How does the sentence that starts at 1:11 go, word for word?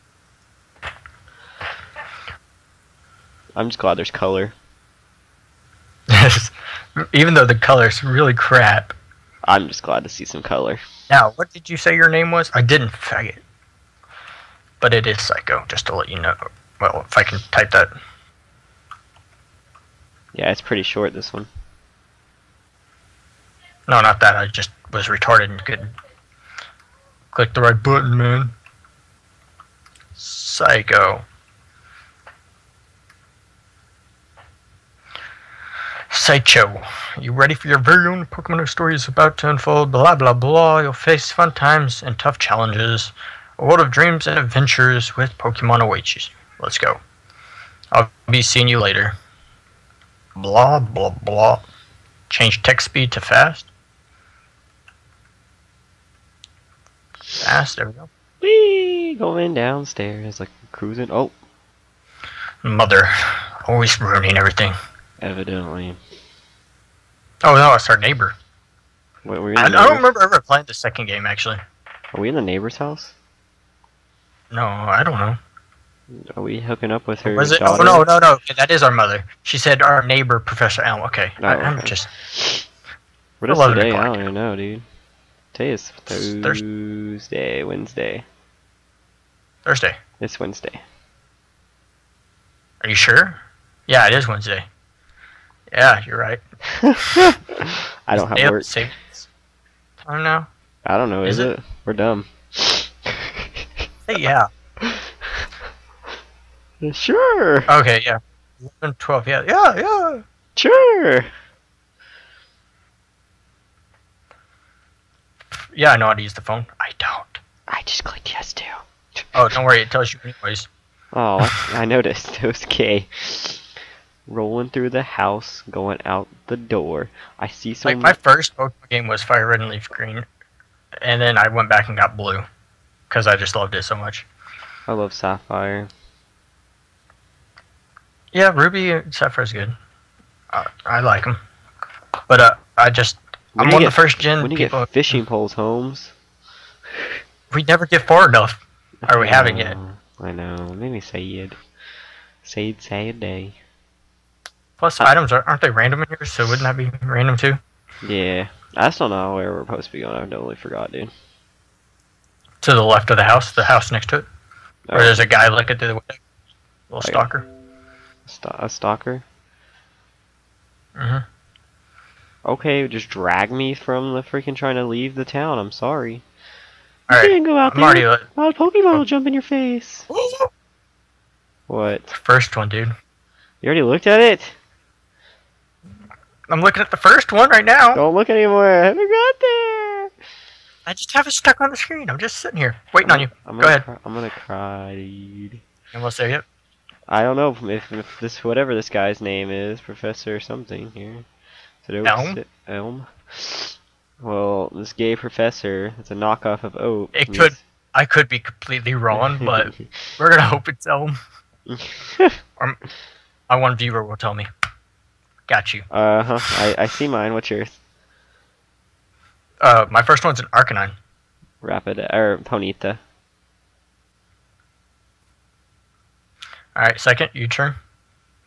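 Are we in the neighbor's house?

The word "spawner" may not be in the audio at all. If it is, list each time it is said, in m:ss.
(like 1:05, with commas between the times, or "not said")
not said.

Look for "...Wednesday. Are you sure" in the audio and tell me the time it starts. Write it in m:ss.
1:30.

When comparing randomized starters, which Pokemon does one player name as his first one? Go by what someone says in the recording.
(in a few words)
Arcanine.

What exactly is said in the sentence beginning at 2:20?
I, I like them, but uh, I just when I'm one of the first gen.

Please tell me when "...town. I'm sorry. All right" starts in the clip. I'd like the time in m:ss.
2:55.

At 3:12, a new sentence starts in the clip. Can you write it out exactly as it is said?
I'm just sitting here waiting I'm, on you.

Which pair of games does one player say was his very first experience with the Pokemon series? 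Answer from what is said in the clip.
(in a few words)
Fire Red and Leaf Green.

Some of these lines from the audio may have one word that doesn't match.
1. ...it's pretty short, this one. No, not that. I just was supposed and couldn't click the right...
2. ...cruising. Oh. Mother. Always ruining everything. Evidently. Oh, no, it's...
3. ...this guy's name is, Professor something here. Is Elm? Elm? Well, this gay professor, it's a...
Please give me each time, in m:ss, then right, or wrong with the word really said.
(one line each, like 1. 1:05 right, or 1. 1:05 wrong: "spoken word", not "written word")
1. 0:20 wrong: "retarded", not "supposed"
2. 1:00 right
3. 3:18 right.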